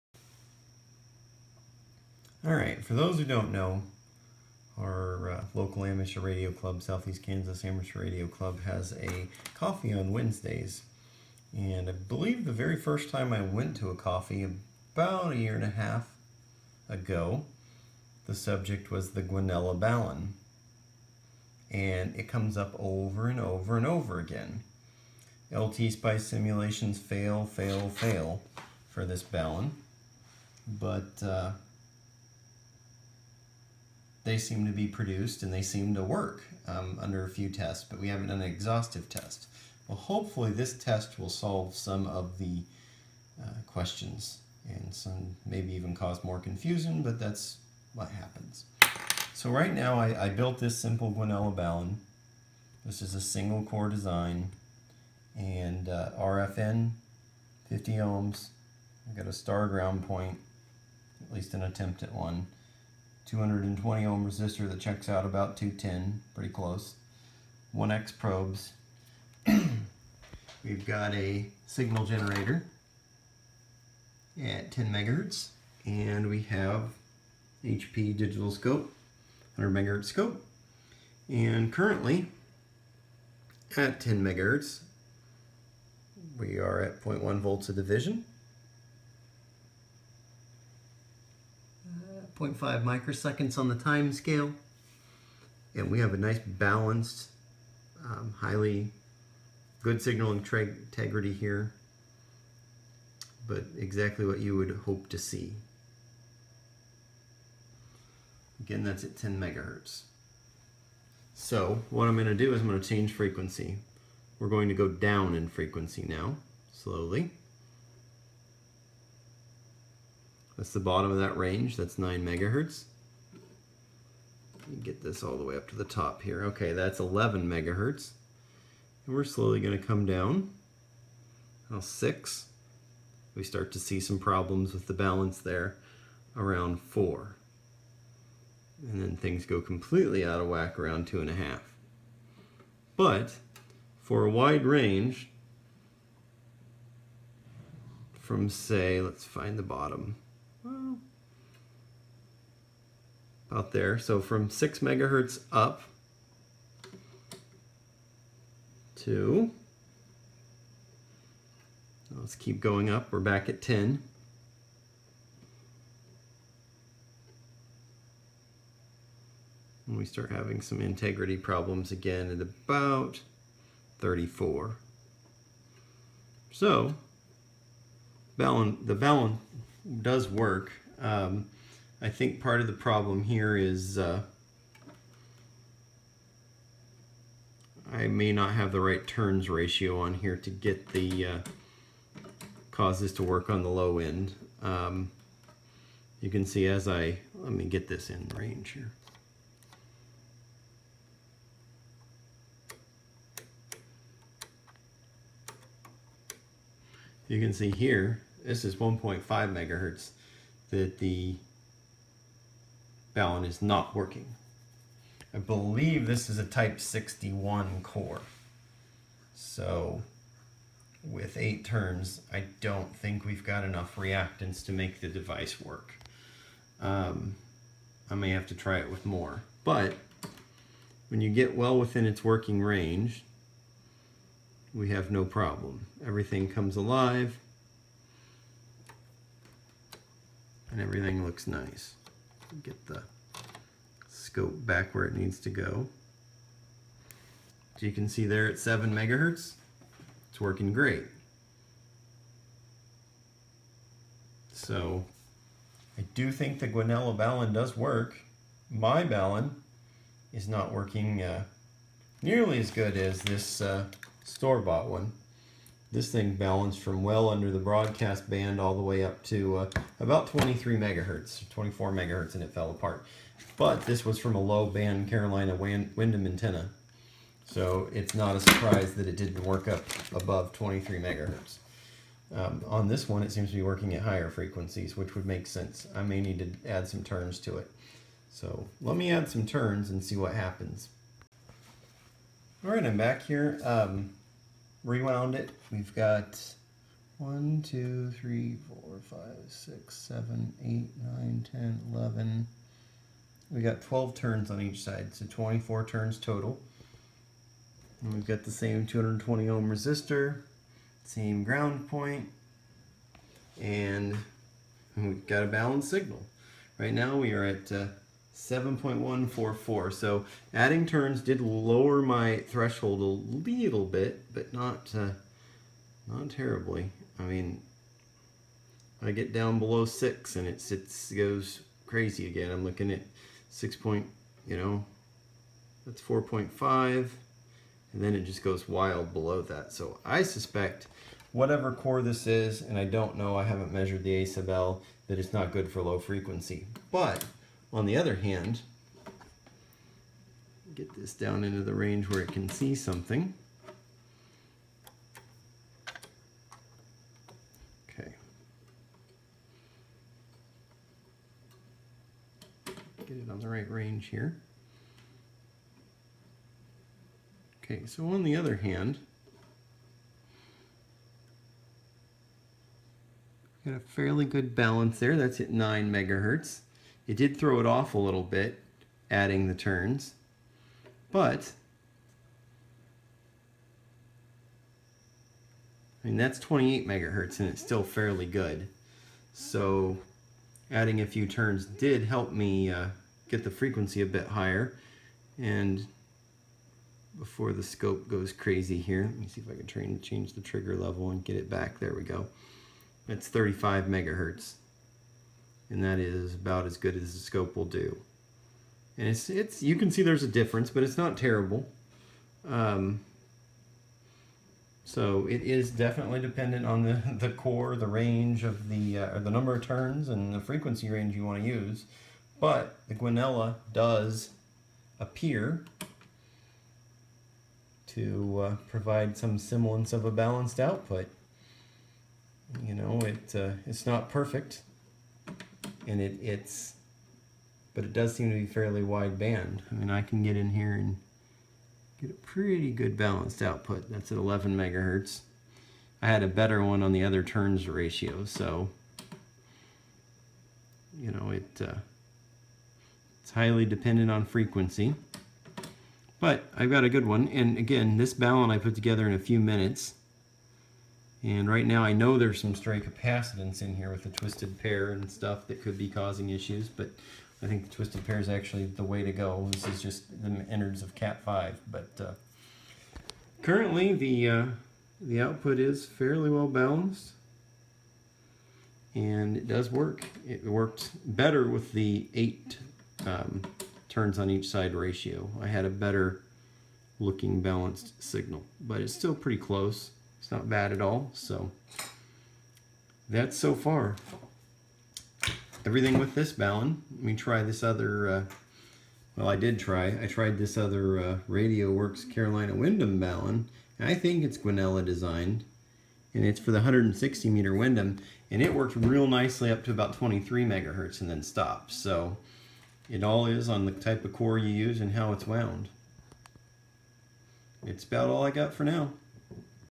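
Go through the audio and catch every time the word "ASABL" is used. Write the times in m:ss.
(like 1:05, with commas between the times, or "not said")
5:44.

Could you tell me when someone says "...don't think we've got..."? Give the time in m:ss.
3:42.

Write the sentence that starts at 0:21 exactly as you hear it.
And it comes up over and over and over again.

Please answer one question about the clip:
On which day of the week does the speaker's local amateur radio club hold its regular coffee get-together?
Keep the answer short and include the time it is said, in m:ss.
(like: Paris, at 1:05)
Wednesdays, at 0:10.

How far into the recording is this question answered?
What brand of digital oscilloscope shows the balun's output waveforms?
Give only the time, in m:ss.
1:17.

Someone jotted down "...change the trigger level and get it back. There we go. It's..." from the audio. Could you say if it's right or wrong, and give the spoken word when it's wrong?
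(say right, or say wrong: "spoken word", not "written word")
right.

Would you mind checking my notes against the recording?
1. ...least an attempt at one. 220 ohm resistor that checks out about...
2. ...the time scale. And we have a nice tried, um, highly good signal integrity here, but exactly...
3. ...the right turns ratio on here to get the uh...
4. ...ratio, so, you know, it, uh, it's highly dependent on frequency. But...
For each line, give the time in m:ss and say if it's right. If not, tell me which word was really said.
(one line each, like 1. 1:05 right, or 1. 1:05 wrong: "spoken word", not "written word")
1. 1:01 right
2. 1:33 wrong: "balanced", not "tried"
3. 3:08 right
4. 7:27 right.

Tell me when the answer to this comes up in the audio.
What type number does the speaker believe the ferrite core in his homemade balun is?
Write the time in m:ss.
3:36.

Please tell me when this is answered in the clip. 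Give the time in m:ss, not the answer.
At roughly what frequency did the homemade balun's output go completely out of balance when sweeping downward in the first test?
2:21.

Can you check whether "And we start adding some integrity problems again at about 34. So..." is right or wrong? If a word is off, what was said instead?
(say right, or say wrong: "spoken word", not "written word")
wrong: "having", not "adding".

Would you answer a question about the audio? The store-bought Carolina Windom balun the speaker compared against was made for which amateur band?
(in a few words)
160 meters.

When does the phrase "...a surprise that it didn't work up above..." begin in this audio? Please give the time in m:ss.
4:38.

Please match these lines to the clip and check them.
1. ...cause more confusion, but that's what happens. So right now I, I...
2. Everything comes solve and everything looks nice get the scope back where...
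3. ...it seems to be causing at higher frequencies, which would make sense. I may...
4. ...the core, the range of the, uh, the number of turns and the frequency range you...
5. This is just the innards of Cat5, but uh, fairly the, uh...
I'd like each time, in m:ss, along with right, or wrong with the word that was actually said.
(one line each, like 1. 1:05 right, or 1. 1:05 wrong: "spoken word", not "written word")
1. 0:45 right
2. 3:56 wrong: "alive", not "solve"
3. 4:43 wrong: "working", not "causing"
4. 6:57 right
5. 7:49 wrong: "currently", not "fairly".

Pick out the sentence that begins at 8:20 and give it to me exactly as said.
I tried this other uh, Radio Works Carolina Windom Balun.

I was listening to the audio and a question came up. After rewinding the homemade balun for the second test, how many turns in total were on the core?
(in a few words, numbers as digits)
24.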